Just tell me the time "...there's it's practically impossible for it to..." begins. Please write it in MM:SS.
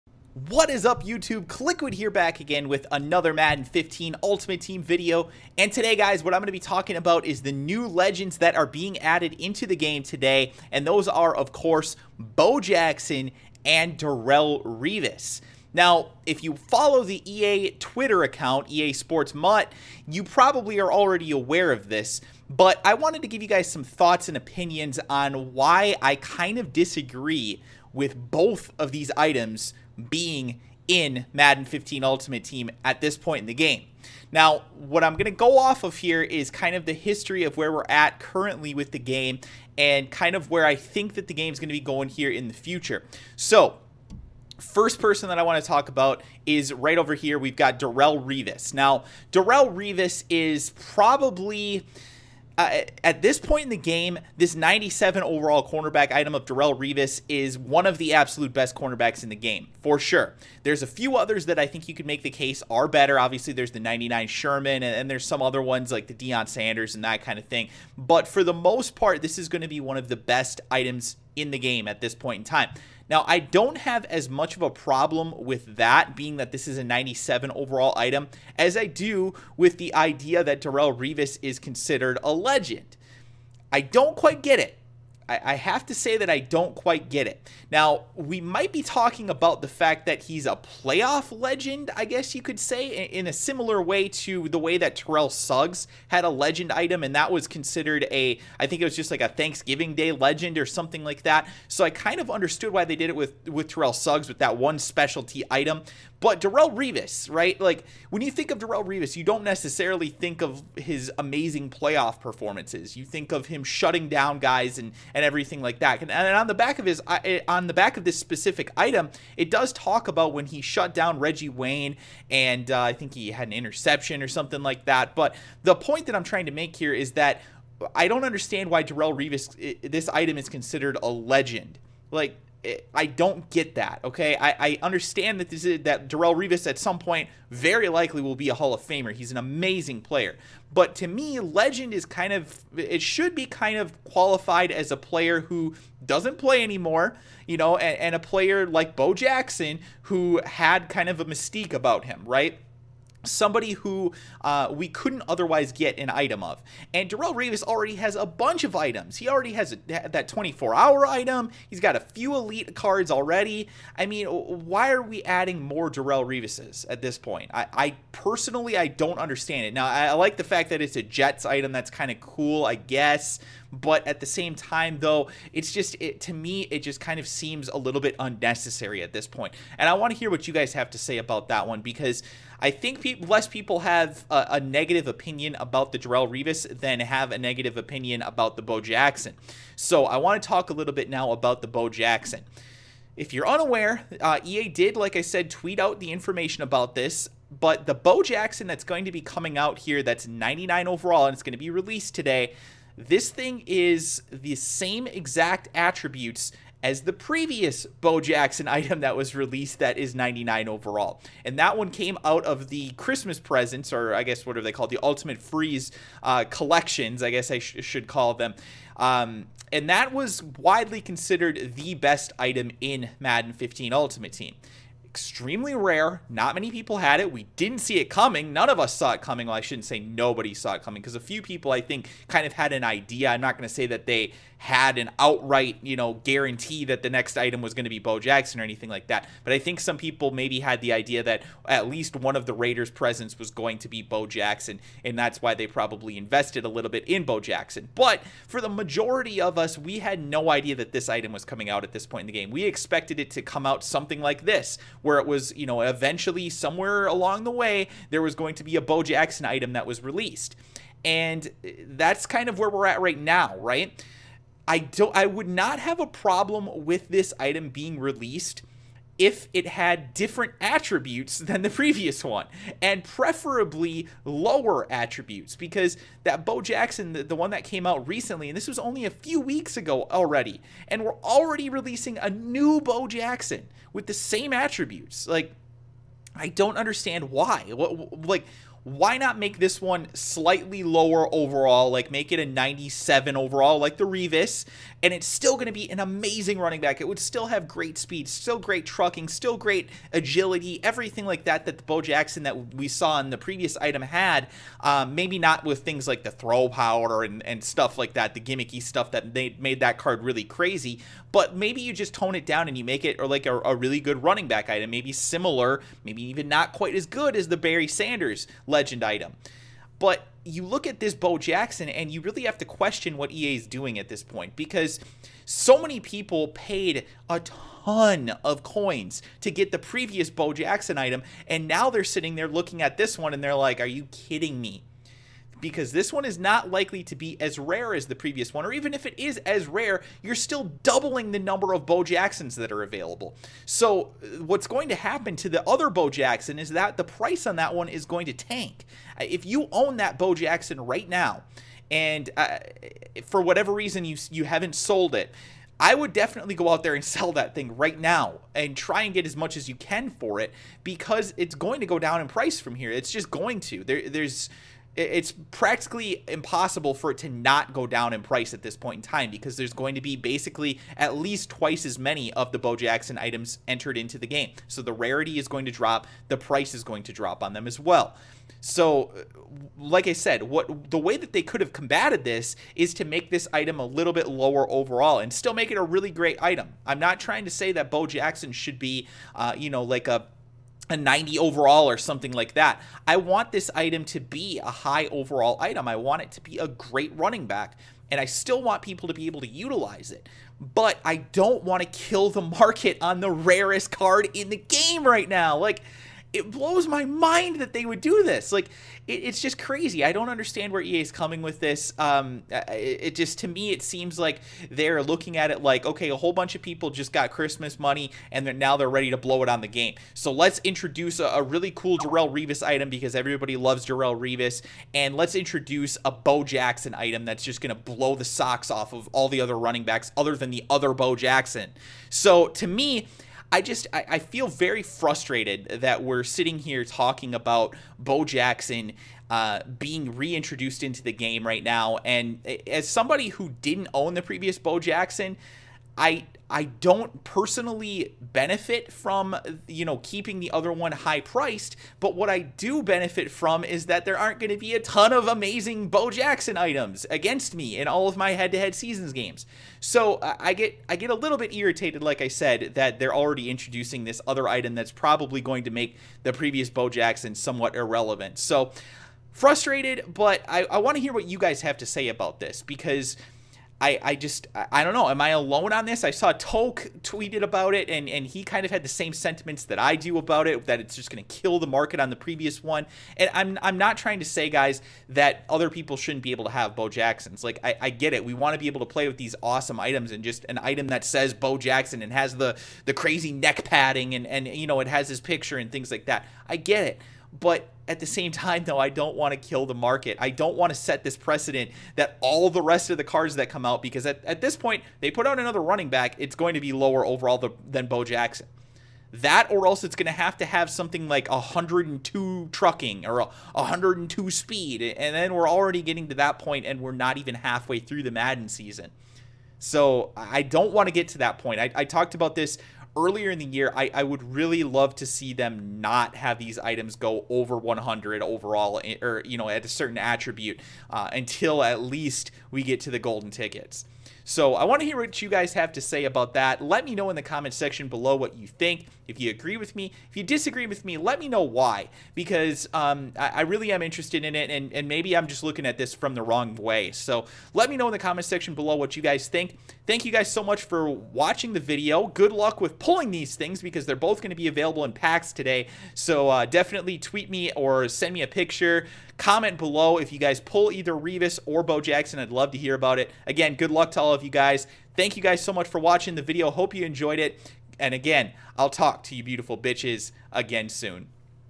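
06:04.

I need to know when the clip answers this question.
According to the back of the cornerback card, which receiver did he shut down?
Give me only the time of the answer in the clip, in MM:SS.
02:01.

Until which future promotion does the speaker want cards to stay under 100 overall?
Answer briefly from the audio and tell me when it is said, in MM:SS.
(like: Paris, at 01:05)
golden tickets, at 08:52.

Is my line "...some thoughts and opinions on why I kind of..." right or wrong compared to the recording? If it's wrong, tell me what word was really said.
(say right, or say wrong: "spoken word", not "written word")
right.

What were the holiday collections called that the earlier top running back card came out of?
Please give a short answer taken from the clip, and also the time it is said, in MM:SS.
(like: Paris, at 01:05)
Ultimate Freeze, at 03:34.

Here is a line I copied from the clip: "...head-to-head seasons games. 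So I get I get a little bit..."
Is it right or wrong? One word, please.
right.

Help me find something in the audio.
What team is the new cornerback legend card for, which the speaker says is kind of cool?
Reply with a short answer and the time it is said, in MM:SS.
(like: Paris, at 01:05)
Jets, at 02:51.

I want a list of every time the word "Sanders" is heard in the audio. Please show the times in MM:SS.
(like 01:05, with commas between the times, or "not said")
01:06, 05:17.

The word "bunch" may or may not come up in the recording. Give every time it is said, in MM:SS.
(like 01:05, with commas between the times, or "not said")
02:38, 06:56.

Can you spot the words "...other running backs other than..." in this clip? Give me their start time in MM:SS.
07:09.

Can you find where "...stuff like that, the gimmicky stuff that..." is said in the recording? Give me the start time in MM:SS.
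05:07.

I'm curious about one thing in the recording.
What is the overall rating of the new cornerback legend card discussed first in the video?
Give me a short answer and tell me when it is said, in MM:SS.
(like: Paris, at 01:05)
97, at 00:54.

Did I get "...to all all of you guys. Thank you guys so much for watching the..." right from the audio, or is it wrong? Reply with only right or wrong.
right.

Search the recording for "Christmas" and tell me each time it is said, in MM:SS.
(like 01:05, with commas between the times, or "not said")
03:32, 06:57.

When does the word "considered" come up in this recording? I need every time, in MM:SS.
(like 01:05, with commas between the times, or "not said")
01:21, 01:37, 02:10, 03:41.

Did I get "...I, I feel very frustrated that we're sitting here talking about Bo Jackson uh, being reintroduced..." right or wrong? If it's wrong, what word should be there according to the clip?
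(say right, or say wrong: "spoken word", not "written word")
right.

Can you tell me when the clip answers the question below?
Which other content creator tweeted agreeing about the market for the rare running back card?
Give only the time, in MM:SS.
07:56.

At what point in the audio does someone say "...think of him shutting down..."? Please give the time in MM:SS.
01:53.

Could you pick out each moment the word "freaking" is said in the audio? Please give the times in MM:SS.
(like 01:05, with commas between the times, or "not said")
not said.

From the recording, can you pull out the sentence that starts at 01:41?
So I kind of understood why they did it with, with Terrell Suggs with that one specialty item.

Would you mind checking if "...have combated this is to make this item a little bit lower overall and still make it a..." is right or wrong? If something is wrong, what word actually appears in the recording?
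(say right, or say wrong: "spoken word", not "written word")
right.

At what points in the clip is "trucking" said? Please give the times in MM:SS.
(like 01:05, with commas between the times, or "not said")
04:58, 08:32.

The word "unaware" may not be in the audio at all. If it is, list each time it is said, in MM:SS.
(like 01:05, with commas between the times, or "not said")
03:13.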